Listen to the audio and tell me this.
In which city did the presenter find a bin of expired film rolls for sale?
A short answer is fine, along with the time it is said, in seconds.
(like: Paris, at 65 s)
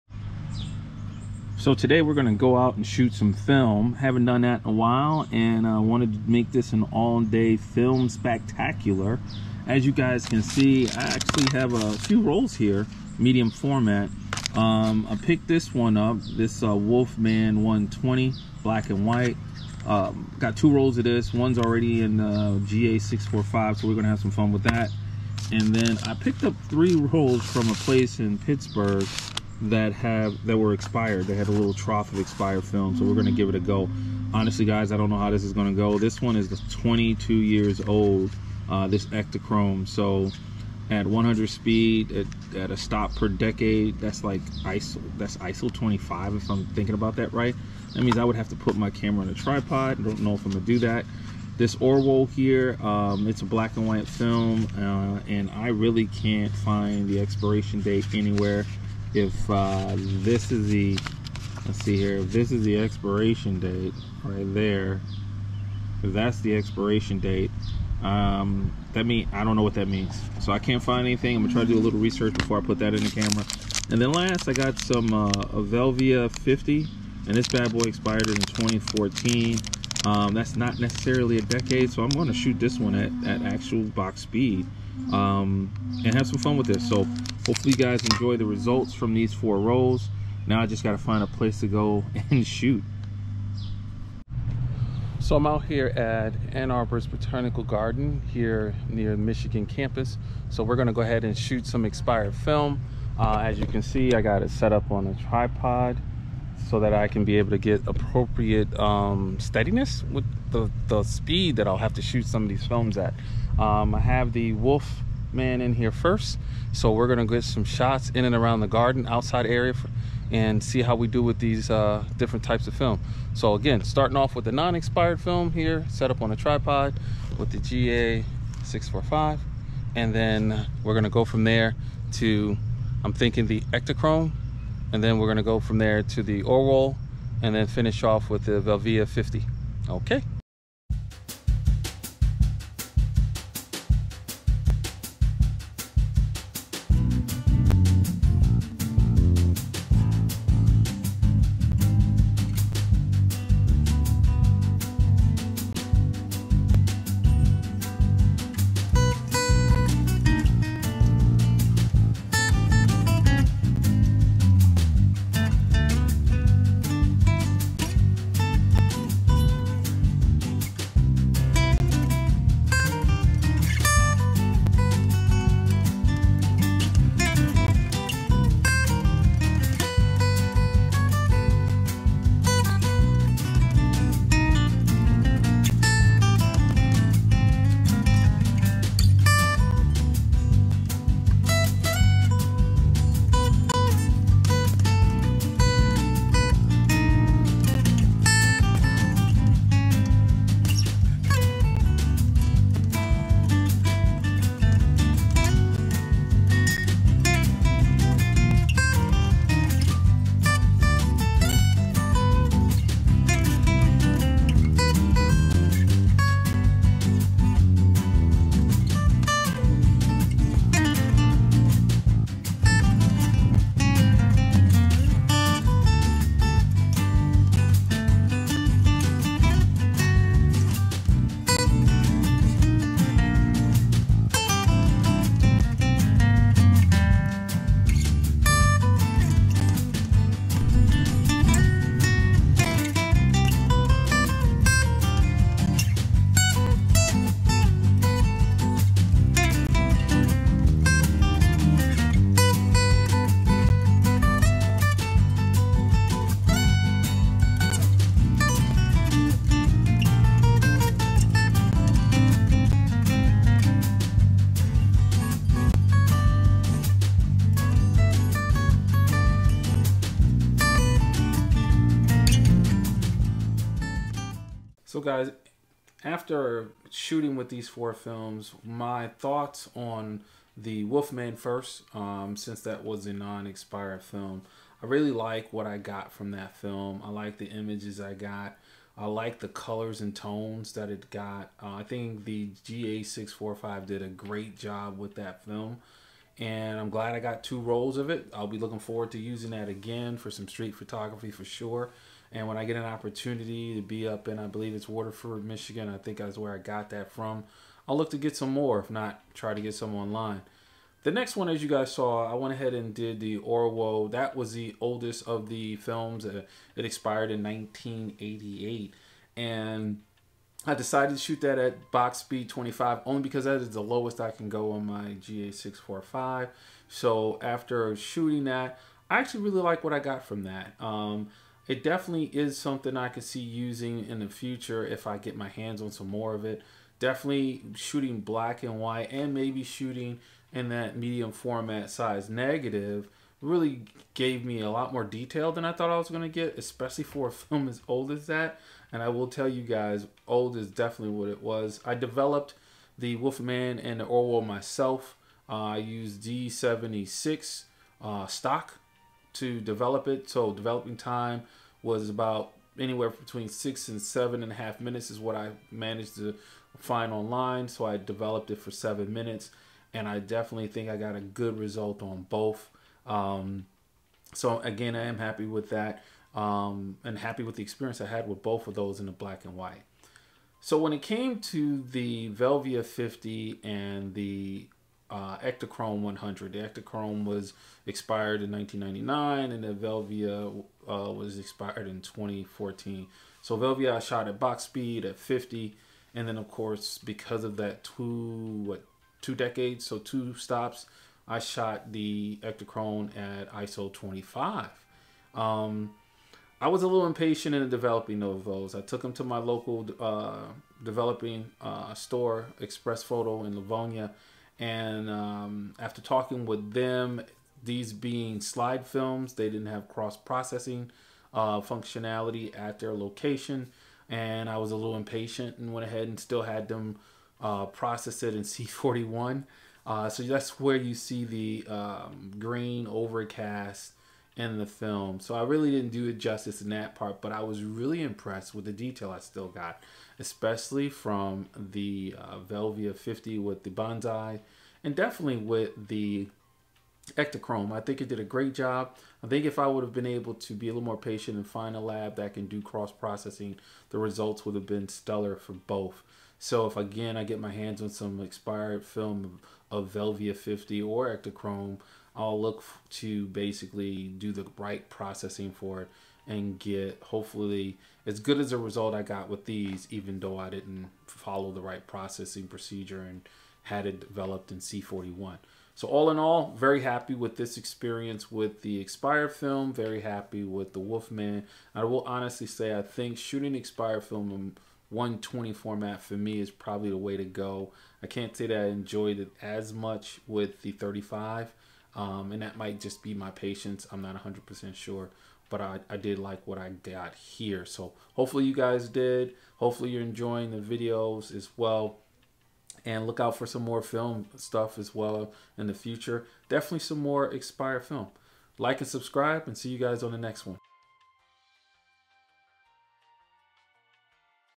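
Pittsburgh, at 28 s.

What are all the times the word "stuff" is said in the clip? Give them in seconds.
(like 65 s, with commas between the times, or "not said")
504 s.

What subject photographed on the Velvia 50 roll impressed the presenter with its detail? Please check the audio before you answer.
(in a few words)
Bonsai.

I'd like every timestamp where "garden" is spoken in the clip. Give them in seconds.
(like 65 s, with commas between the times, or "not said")
97 s, 118 s.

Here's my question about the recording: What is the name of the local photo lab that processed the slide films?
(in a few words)
Express Photo.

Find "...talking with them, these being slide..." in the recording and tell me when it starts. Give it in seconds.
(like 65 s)
416 s.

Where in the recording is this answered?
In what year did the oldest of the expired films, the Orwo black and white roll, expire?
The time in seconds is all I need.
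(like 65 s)
317 s.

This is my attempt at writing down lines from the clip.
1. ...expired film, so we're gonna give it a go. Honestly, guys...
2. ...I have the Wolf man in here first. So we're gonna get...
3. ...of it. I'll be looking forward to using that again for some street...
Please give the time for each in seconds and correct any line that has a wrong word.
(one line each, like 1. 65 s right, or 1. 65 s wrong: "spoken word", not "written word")
1. 32 s right
2. 113 s right
3. 297 s right.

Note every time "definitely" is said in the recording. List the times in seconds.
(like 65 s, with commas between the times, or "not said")
331 s, 336 s, 350 s, 370 s, 444 s, 506 s.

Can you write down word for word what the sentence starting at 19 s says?
Um, got two rolls of this, one's already in uh, GA645, so we're gonna have some fun with that.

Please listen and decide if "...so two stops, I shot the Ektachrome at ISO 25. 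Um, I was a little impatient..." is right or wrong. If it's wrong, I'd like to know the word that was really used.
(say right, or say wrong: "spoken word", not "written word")
right.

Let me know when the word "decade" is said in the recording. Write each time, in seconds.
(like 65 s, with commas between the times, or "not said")
43 s, 81 s, 399 s.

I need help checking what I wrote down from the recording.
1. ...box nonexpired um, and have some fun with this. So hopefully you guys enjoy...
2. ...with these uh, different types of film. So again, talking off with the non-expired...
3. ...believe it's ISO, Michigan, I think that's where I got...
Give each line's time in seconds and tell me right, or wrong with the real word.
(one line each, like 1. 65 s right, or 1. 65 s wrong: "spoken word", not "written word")
1. 83 s wrong: "speed", not "nonexpired"
2. 121 s wrong: "starting", not "talking"
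3. 304 s wrong: "Waterford", not "ISO".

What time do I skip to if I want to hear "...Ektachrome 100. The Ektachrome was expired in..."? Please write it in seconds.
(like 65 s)
385 s.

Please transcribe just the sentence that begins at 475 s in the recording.
So all in all, very happy with this experience with the expired film.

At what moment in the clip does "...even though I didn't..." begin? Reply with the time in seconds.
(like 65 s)
469 s.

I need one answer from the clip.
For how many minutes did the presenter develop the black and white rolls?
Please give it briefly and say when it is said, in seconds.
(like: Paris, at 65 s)
7, at 368 s.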